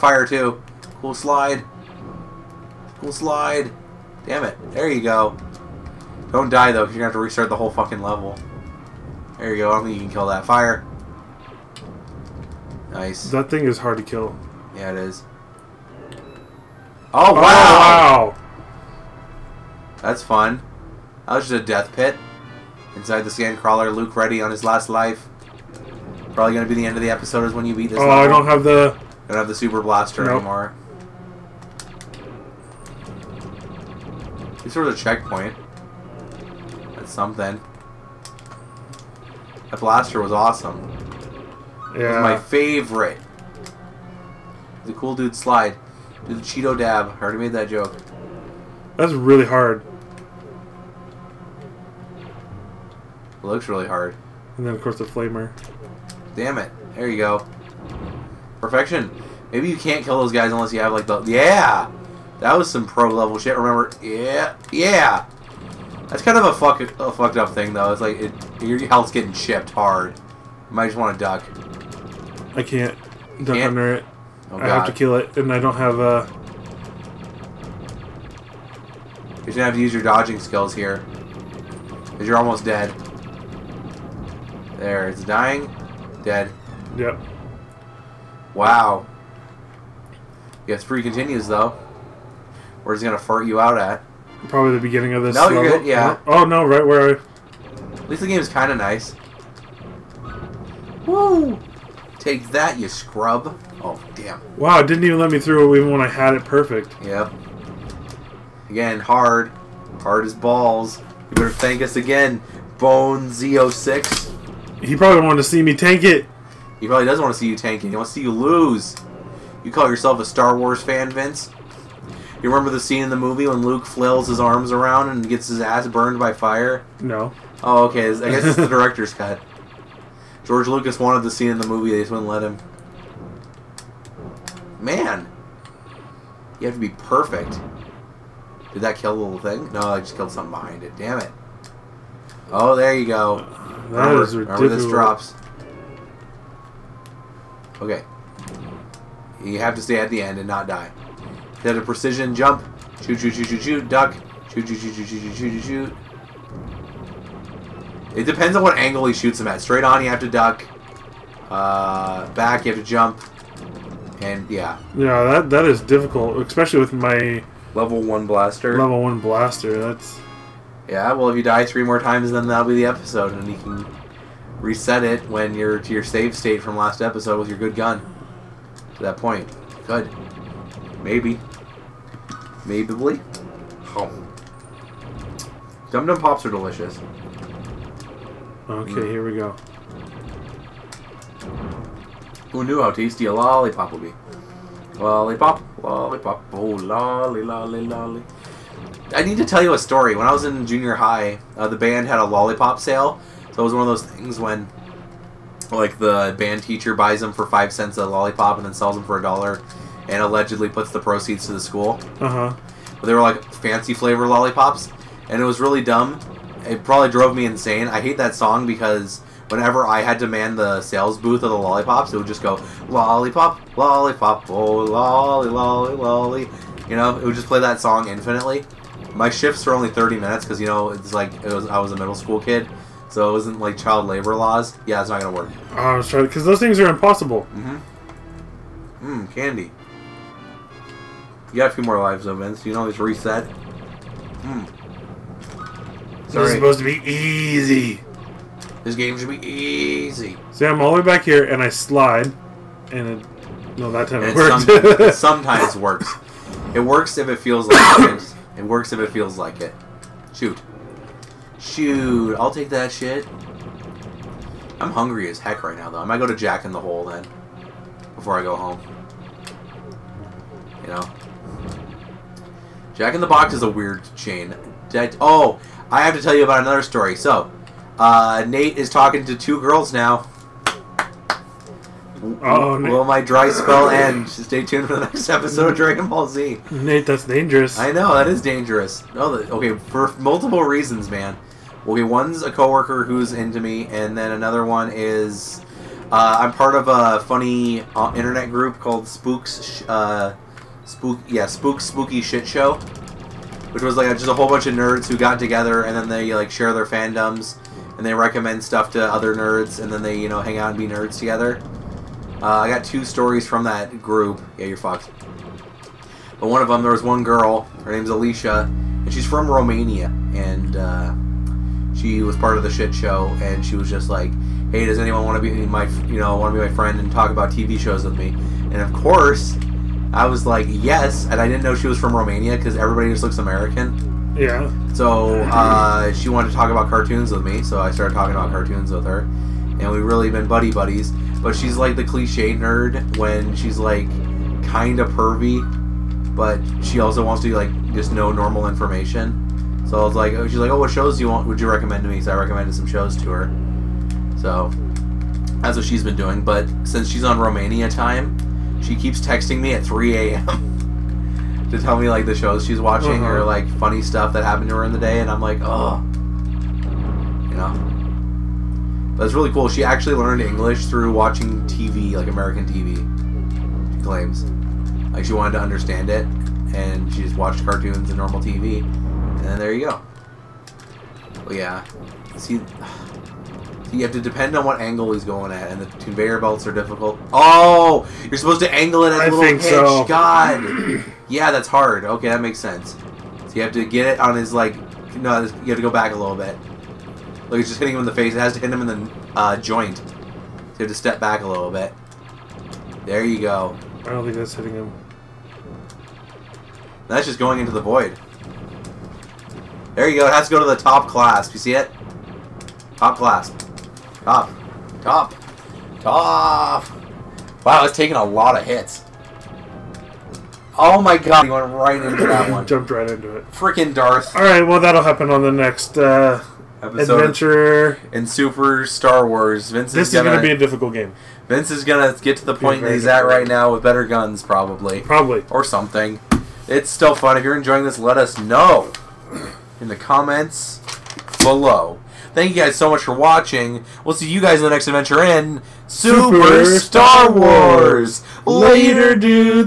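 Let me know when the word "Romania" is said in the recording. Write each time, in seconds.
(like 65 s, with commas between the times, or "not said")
319 s, 332 s, 357 s.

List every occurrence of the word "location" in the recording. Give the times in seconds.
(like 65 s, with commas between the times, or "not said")
not said.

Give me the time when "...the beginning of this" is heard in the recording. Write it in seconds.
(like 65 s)
94 s.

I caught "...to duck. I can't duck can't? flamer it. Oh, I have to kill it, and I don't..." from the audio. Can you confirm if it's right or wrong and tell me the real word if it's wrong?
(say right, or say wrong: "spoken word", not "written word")
wrong: "under", not "flamer".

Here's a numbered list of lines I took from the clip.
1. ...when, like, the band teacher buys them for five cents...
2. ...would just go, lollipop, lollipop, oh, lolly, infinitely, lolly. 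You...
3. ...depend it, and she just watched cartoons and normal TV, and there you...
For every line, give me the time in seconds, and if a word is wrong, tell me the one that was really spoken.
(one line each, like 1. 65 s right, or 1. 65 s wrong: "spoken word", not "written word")
1. 204 s right
2. 222 s wrong: "lolly", not "infinitely"
3. 375 s wrong: "understand", not "depend".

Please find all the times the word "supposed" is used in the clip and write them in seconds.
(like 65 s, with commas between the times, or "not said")
246 s, 388 s.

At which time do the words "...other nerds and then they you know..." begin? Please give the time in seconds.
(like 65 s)
309 s.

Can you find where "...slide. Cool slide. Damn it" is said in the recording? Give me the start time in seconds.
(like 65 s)
1 s.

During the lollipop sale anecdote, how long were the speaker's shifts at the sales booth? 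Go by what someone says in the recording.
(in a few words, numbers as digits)
30 minutes.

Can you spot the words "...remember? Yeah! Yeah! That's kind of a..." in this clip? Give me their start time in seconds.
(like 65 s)
63 s.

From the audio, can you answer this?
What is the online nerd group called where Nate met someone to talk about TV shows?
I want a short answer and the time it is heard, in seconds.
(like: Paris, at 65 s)
Spooky Shit Show, at 301 s.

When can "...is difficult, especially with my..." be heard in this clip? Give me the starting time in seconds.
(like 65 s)
165 s.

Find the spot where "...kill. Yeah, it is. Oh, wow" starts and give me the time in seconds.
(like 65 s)
14 s.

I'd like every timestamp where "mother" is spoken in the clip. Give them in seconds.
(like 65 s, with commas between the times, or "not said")
not said.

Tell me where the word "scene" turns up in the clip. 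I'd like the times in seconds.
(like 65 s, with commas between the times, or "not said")
122 s, 131 s.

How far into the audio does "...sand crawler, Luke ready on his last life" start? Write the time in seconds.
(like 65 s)
23 s.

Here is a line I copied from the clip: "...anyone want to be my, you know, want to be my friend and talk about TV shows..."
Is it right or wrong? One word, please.
right.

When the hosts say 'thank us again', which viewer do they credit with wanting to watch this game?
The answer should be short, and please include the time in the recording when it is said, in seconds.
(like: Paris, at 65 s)
Bone Z06, at 112 s.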